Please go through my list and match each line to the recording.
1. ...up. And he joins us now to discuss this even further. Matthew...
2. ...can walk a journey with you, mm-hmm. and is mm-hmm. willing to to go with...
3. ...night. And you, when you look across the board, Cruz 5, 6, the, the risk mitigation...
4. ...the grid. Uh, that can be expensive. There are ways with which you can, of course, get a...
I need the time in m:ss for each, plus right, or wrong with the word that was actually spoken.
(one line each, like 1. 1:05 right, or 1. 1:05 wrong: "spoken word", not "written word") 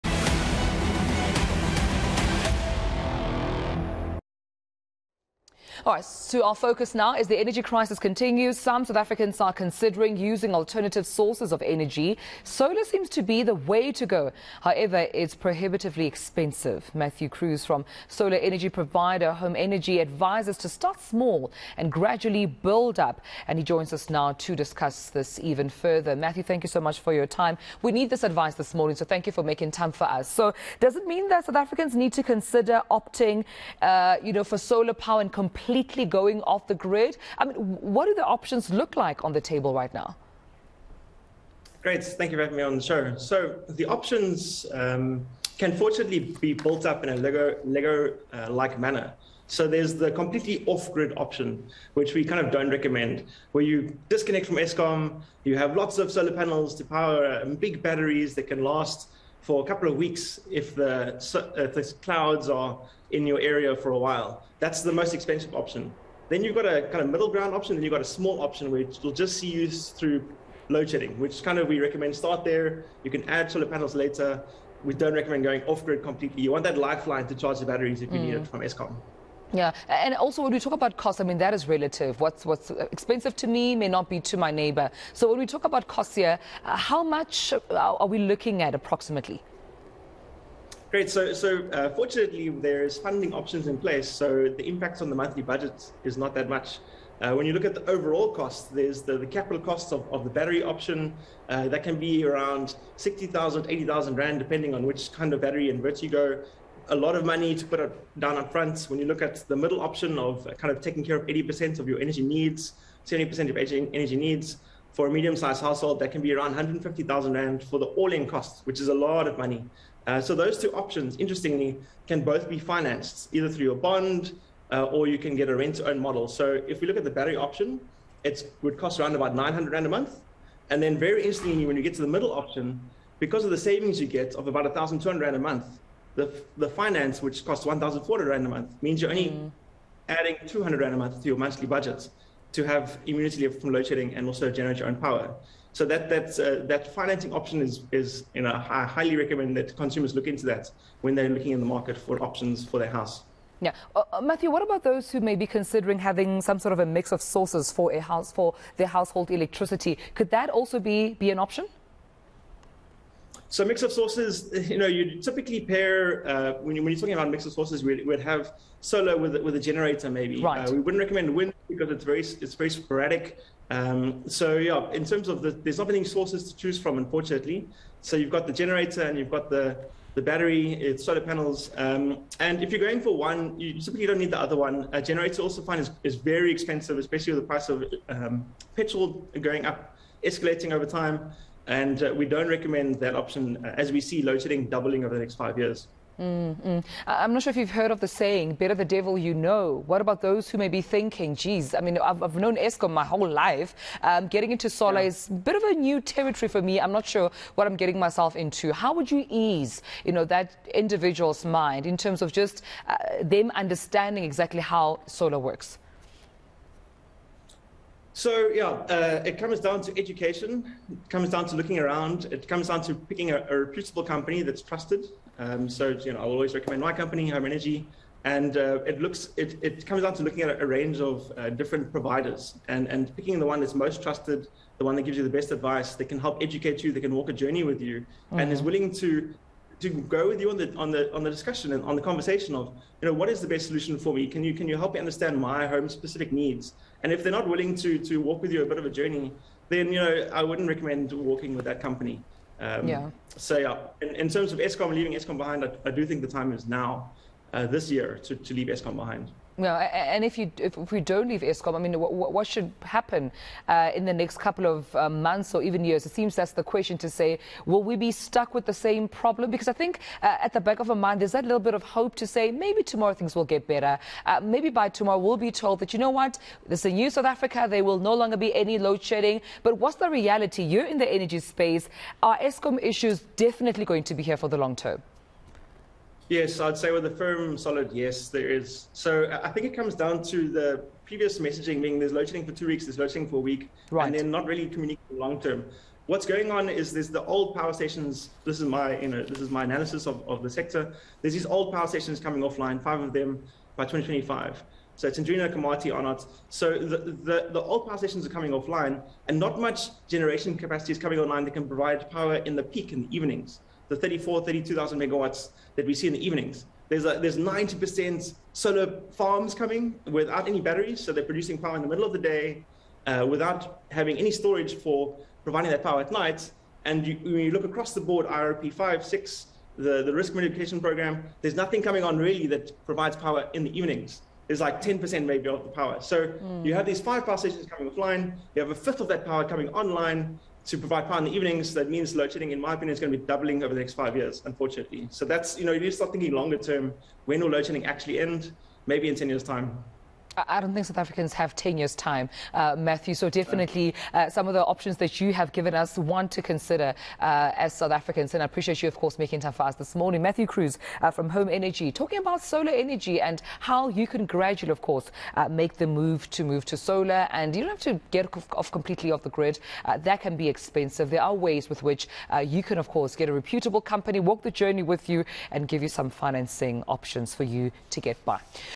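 1. 0:22 right
2. 3:57 right
3. 5:26 wrong: "IRP", not "Cruz"
4. 6:09 right.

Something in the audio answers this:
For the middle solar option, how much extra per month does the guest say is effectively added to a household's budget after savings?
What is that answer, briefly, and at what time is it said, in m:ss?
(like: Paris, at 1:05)
200 rand, at 2:20.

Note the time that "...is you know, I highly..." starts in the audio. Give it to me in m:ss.
2:27.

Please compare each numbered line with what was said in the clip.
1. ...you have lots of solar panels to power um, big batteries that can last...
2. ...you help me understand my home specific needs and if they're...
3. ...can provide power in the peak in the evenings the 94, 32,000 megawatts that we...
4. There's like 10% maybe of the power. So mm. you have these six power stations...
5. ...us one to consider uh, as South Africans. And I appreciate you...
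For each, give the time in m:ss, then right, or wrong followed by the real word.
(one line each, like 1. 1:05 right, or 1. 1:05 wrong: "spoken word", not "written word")
1. 0:55 right
2. 4:04 right
3. 5:11 wrong: "34", not "94"
4. 5:34 wrong: "five", not "six"
5. 5:55 right.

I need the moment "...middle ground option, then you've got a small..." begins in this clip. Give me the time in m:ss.
1:07.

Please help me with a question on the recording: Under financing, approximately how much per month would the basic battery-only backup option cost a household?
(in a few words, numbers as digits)
900 rand.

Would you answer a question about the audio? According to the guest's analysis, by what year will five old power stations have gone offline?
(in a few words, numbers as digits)
2025.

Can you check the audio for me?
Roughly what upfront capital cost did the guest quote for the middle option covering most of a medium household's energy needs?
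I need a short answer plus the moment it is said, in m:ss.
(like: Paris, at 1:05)
150,000 rand, at 1:56.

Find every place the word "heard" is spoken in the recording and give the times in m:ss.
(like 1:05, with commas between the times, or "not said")
3:17.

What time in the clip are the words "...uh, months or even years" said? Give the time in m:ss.
4:24.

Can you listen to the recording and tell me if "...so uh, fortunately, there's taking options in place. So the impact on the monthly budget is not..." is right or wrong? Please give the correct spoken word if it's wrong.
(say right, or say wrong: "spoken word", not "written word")
wrong: "funding", not "taking".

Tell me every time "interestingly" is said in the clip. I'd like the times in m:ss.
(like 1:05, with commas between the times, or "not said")
2:01, 2:11.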